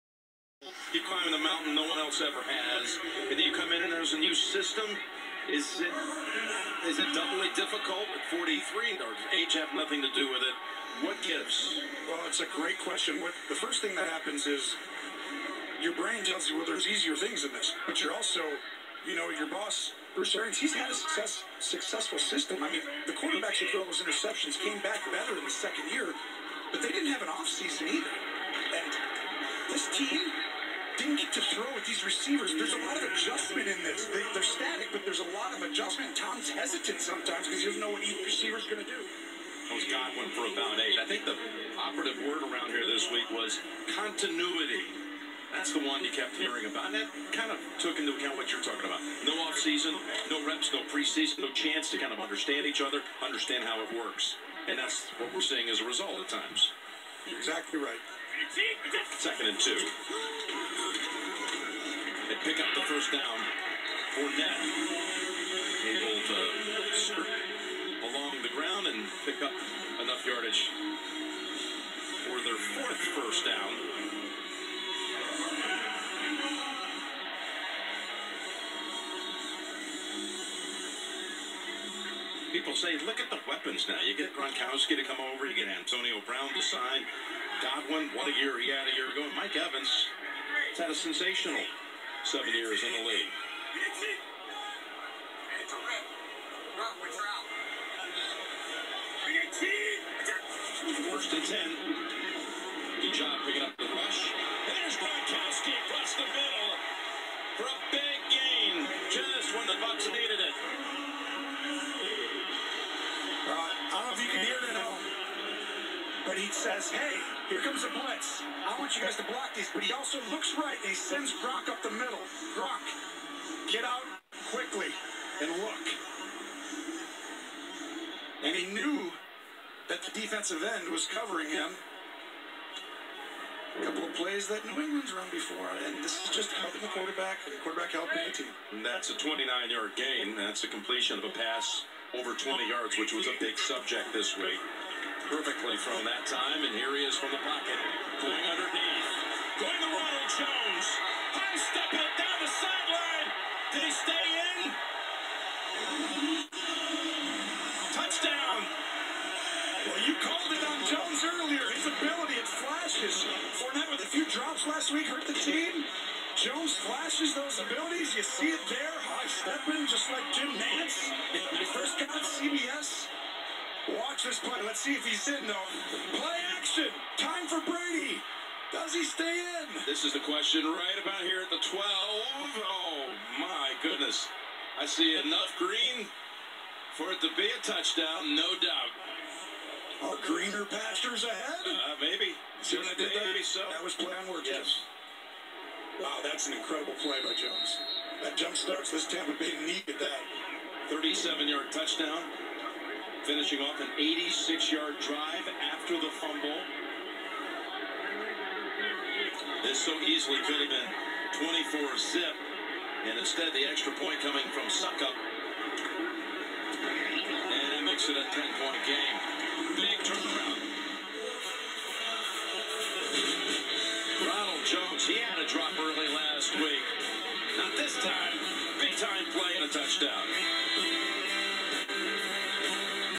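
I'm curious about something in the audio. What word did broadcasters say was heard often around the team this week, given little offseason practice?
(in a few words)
Continuity.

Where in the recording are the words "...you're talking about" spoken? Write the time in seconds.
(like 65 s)
48 s.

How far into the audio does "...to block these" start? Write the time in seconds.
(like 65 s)
119 s.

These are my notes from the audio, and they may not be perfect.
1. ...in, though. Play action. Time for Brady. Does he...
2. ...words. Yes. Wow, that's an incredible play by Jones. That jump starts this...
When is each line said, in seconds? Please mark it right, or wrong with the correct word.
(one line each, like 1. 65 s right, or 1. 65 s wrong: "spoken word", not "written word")
1. 175 s right
2. 194 s right.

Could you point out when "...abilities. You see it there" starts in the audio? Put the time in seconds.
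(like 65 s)
167 s.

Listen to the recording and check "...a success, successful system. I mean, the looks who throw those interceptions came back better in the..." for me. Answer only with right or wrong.
wrong.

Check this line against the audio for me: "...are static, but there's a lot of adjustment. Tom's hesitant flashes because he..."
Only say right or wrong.
wrong.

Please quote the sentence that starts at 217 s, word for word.
And it makes it a 10-point game.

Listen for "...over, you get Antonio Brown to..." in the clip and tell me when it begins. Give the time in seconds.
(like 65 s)
85 s.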